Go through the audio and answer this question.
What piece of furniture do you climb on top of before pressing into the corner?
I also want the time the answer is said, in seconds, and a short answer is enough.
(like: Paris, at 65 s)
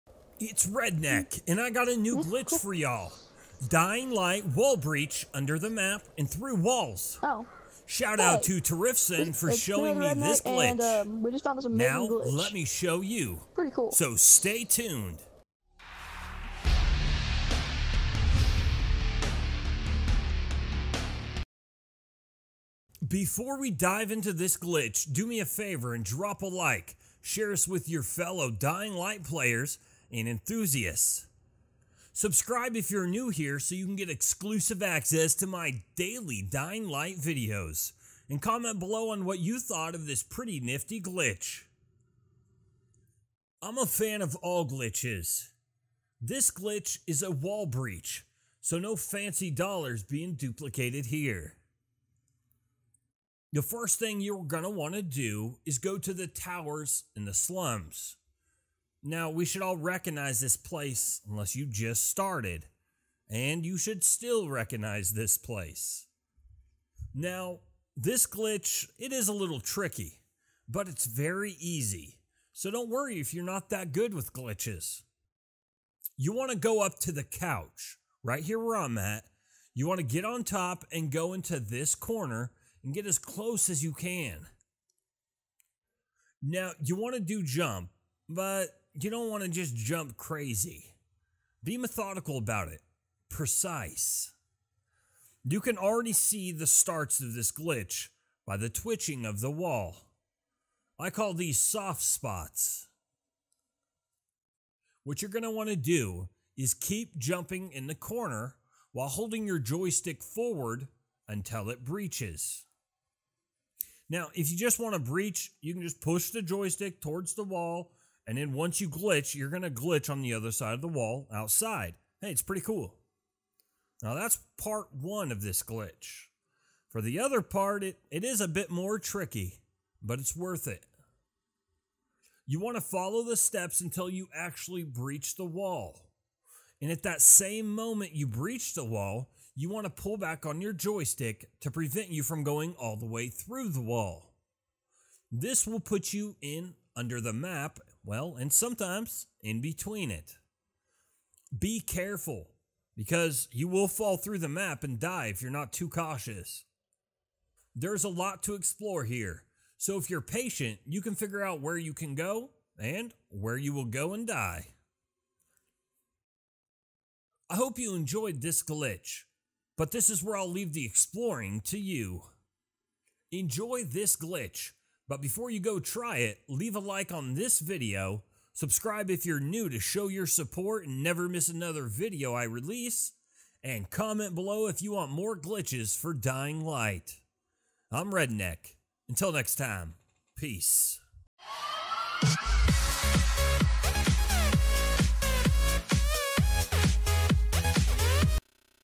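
couch, at 77 s.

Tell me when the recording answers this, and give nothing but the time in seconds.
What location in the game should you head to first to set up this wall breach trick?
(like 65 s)
56 s.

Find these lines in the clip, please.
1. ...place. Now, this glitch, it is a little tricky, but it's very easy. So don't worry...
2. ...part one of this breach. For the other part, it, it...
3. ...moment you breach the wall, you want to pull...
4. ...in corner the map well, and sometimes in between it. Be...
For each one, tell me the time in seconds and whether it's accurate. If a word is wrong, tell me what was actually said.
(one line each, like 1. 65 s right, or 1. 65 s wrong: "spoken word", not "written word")
1. 65 s right
2. 124 s wrong: "glitch", not "breach"
3. 137 s right
4. 146 s wrong: "under", not "corner".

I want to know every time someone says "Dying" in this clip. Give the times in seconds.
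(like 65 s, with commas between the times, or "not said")
3 s, 28 s, 36 s, 186 s.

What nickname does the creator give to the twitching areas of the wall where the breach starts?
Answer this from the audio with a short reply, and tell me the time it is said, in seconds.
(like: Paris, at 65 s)
soft spots, at 101 s.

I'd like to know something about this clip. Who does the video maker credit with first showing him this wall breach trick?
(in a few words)
Tarifson.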